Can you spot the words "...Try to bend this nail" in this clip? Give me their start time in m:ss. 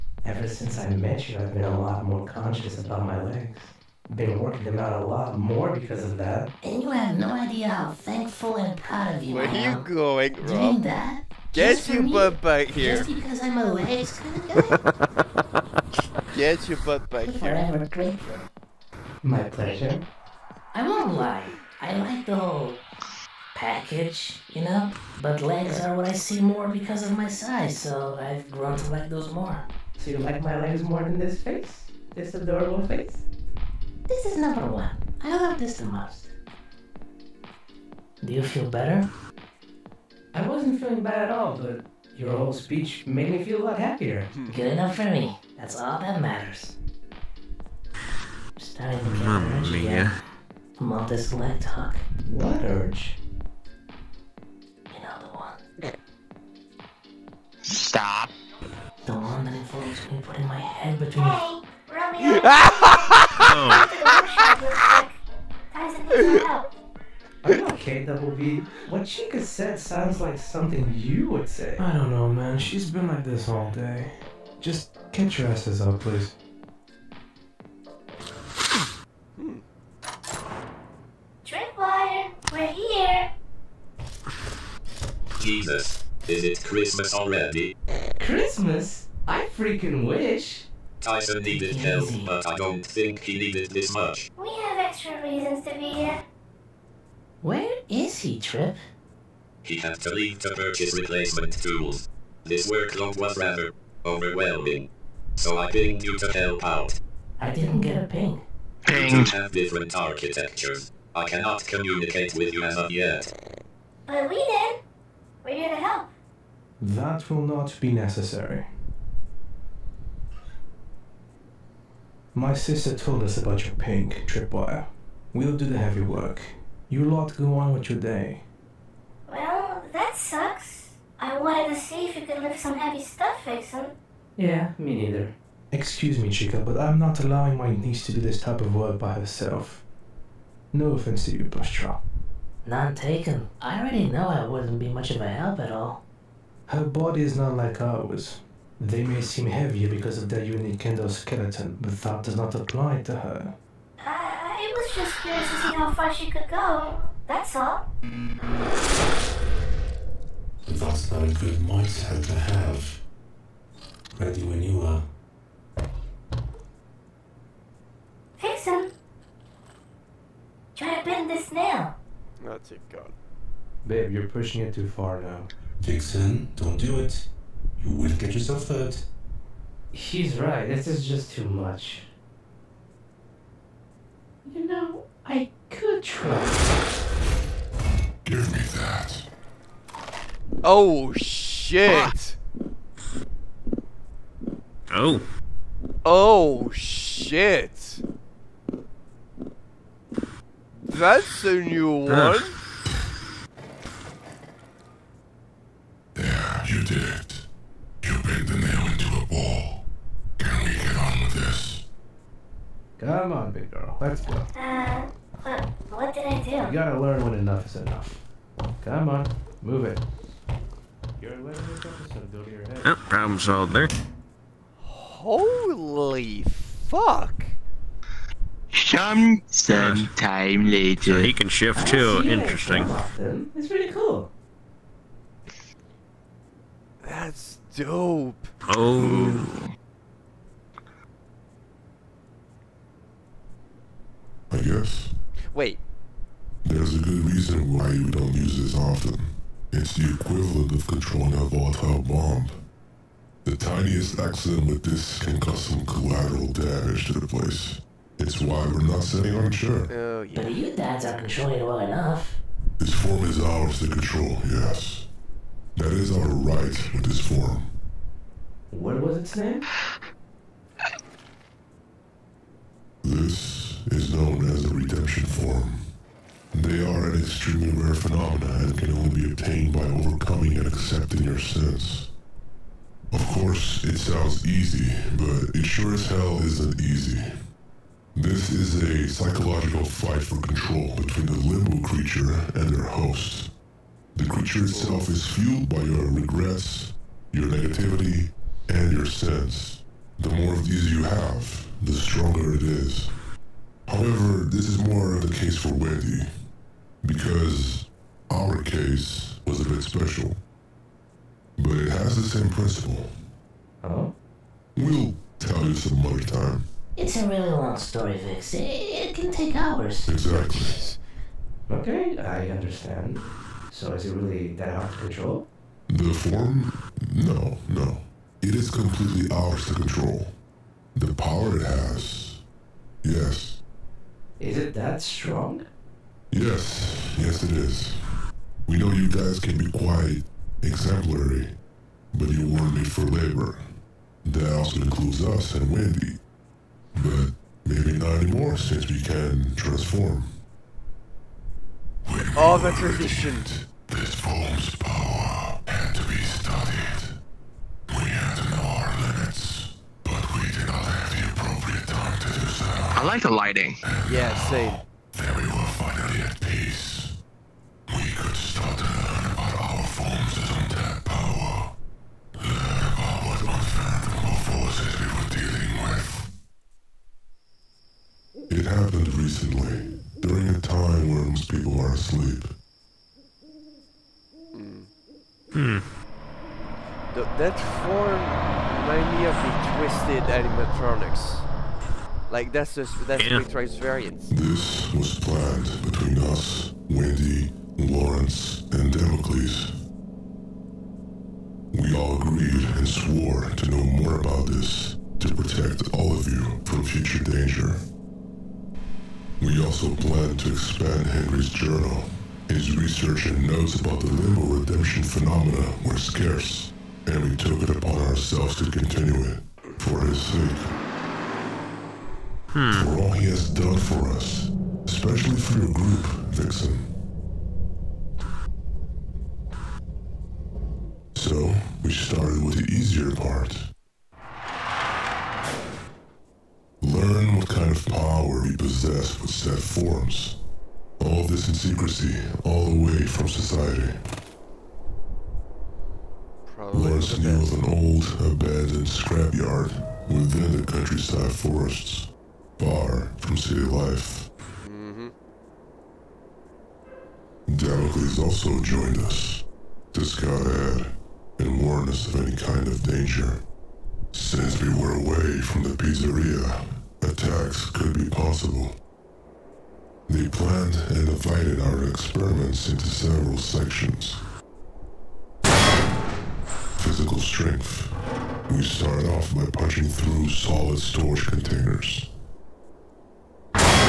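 2:50.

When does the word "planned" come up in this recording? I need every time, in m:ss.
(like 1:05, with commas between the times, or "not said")
6:35, 6:49, 7:50.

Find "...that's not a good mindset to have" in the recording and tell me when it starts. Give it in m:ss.
2:41.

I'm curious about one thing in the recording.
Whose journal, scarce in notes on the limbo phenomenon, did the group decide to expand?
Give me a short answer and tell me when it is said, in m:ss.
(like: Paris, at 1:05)
Henry, at 6:51.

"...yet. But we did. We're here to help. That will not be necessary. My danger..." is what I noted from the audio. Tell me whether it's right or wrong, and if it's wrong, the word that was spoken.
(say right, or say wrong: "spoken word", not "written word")
wrong: "sister", not "danger".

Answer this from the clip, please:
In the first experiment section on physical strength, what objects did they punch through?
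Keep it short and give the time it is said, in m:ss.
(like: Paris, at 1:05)
Solid storage containers, at 8:00.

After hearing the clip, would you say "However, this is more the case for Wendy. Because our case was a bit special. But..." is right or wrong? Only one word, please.
right.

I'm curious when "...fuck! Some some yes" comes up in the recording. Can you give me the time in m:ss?
3:46.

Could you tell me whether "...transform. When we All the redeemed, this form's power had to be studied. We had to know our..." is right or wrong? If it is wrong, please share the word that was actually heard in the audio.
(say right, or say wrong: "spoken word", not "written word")
right.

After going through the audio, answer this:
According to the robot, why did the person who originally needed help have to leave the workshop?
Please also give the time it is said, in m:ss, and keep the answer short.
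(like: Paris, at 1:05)
To purchase replacement tools, at 1:40.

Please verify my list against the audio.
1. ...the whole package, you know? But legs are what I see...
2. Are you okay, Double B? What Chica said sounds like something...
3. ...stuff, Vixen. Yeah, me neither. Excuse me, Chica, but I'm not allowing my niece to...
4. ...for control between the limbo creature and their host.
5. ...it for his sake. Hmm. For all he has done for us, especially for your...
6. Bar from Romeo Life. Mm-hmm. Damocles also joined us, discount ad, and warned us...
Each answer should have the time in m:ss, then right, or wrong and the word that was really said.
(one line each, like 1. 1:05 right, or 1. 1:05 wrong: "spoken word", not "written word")
1. 0:22 right
2. 1:07 right
3. 2:13 right
4. 4:50 right
5. 6:59 right
6. 7:32 wrong: "City", not "Romeo".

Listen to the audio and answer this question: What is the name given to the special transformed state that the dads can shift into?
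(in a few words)
The redemption form.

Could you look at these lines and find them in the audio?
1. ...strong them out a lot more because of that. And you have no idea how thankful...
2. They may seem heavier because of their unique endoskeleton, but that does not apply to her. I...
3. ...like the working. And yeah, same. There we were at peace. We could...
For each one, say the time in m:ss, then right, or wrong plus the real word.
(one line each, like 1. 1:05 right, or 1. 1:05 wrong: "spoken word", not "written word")
1. 0:04 wrong: "working", not "strong"
2. 2:28 right
3. 6:03 wrong: "lighting", not "working".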